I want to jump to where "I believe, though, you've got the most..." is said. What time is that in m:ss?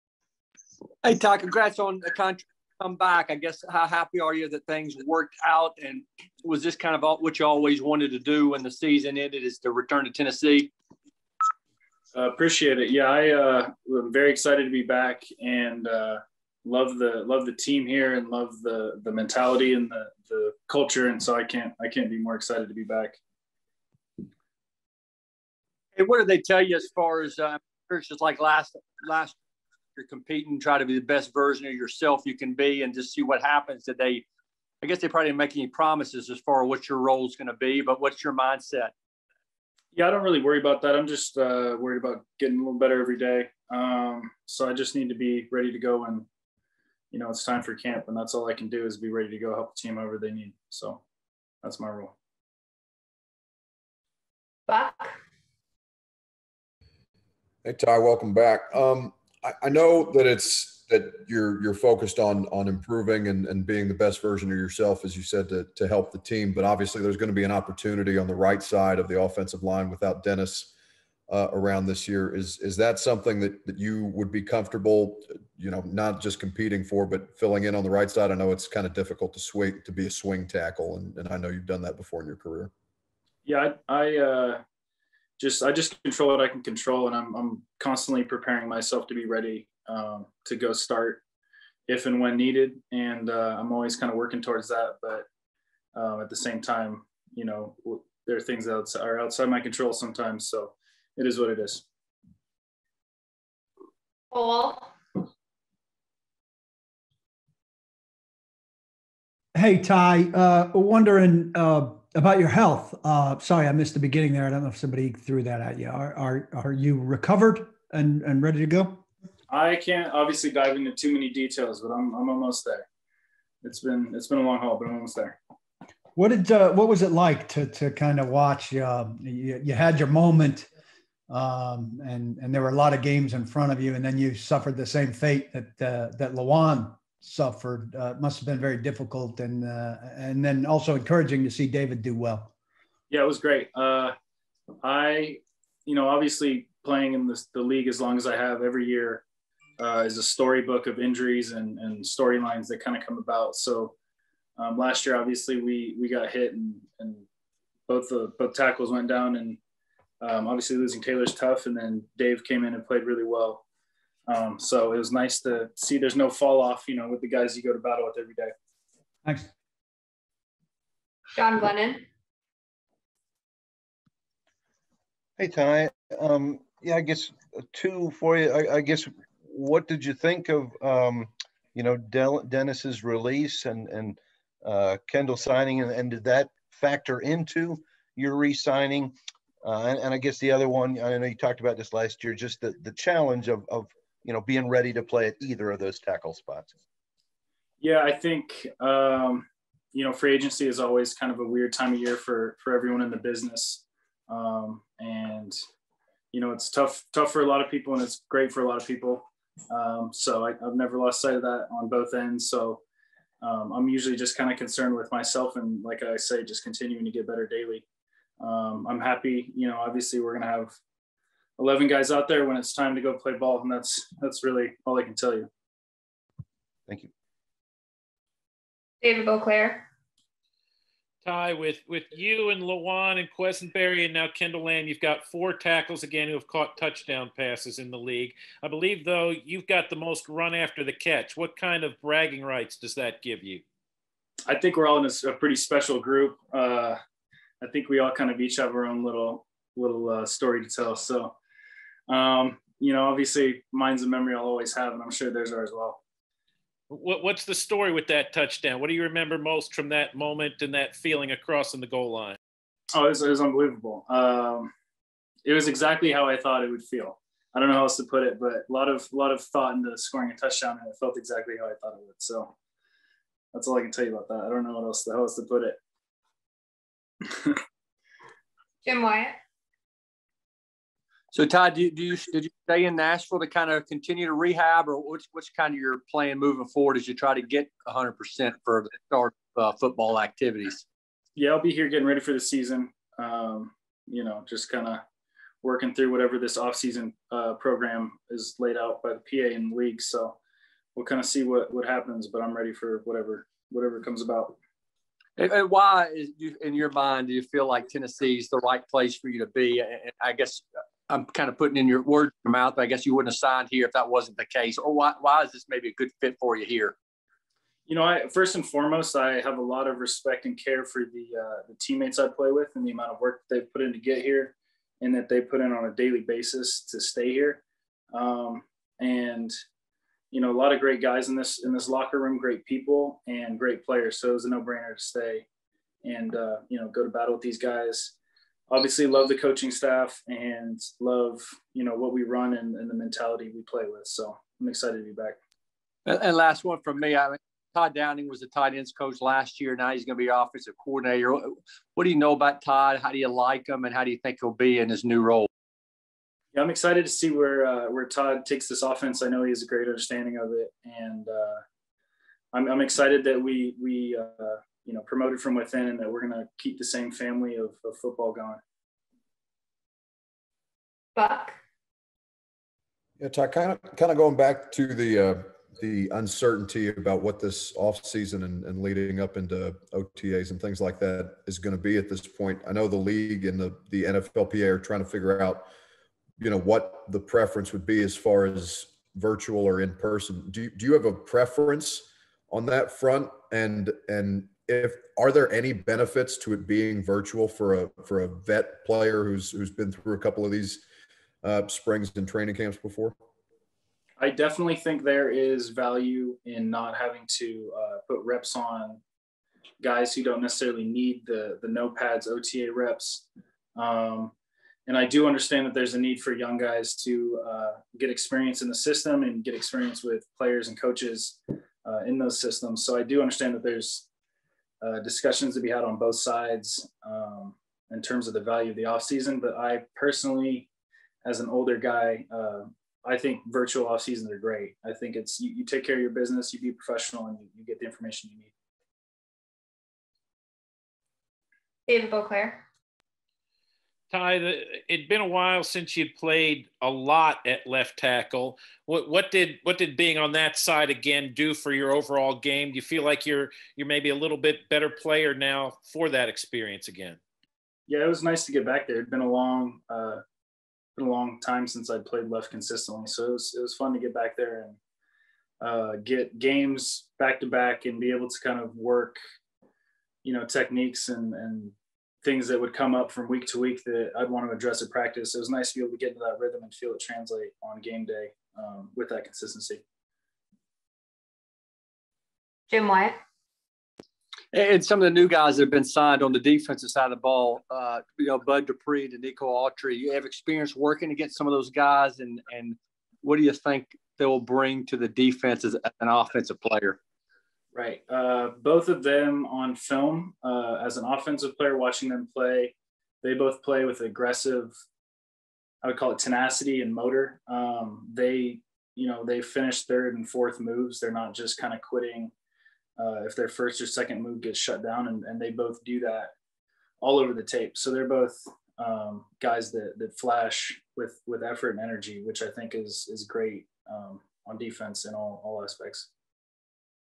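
3:58.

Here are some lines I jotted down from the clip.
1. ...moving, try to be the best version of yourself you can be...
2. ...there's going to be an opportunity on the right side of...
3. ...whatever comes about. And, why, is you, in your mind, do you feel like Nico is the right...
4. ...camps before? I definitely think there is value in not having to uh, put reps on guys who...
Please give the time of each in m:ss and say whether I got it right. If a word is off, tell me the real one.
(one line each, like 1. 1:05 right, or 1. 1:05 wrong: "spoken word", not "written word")
1. 0:30 wrong: "competing", not "moving"
2. 1:07 right
3. 5:03 wrong: "Tennessee", not "Nico"
4. 6:42 right.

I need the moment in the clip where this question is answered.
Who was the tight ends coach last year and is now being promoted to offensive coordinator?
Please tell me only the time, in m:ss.
5:47.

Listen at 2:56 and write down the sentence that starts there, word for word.
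Um, yeah, I guess uh, two for you.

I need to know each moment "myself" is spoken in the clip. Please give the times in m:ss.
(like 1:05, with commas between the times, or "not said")
1:28, 3:35.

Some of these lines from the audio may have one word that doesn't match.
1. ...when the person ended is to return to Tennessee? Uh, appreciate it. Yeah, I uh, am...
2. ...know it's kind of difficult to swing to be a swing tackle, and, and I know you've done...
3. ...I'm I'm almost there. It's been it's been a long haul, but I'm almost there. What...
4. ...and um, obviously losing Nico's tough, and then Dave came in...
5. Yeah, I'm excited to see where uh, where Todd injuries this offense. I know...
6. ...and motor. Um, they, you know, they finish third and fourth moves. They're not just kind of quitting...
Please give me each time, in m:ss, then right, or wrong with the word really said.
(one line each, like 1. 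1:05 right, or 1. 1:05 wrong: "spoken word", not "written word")
1. 0:08 wrong: "season", not "person"
2. 1:18 right
3. 2:01 right
4. 2:39 wrong: "Taylor", not "Nico"
5. 5:56 wrong: "takes", not "injuries"
6. 8:26 right.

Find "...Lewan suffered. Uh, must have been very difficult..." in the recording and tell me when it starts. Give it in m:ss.
2:16.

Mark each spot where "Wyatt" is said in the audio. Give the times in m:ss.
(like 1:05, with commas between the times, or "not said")
4:39, 8:02.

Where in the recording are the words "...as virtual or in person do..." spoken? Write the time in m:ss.
6:28.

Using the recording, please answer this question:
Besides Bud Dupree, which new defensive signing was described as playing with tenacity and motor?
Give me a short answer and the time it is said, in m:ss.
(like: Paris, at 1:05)
Nico Autry, at 8:09.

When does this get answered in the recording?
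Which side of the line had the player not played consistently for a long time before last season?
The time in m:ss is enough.
7:27.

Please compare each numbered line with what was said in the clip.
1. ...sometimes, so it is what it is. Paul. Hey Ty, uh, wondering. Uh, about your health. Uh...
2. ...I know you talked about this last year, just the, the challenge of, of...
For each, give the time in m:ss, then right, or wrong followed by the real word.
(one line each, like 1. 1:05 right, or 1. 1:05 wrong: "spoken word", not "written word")
1. 1:39 right
2. 3:10 right.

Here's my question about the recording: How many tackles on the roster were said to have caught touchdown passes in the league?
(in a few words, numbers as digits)
four.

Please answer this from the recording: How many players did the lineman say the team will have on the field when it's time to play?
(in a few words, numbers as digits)
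11.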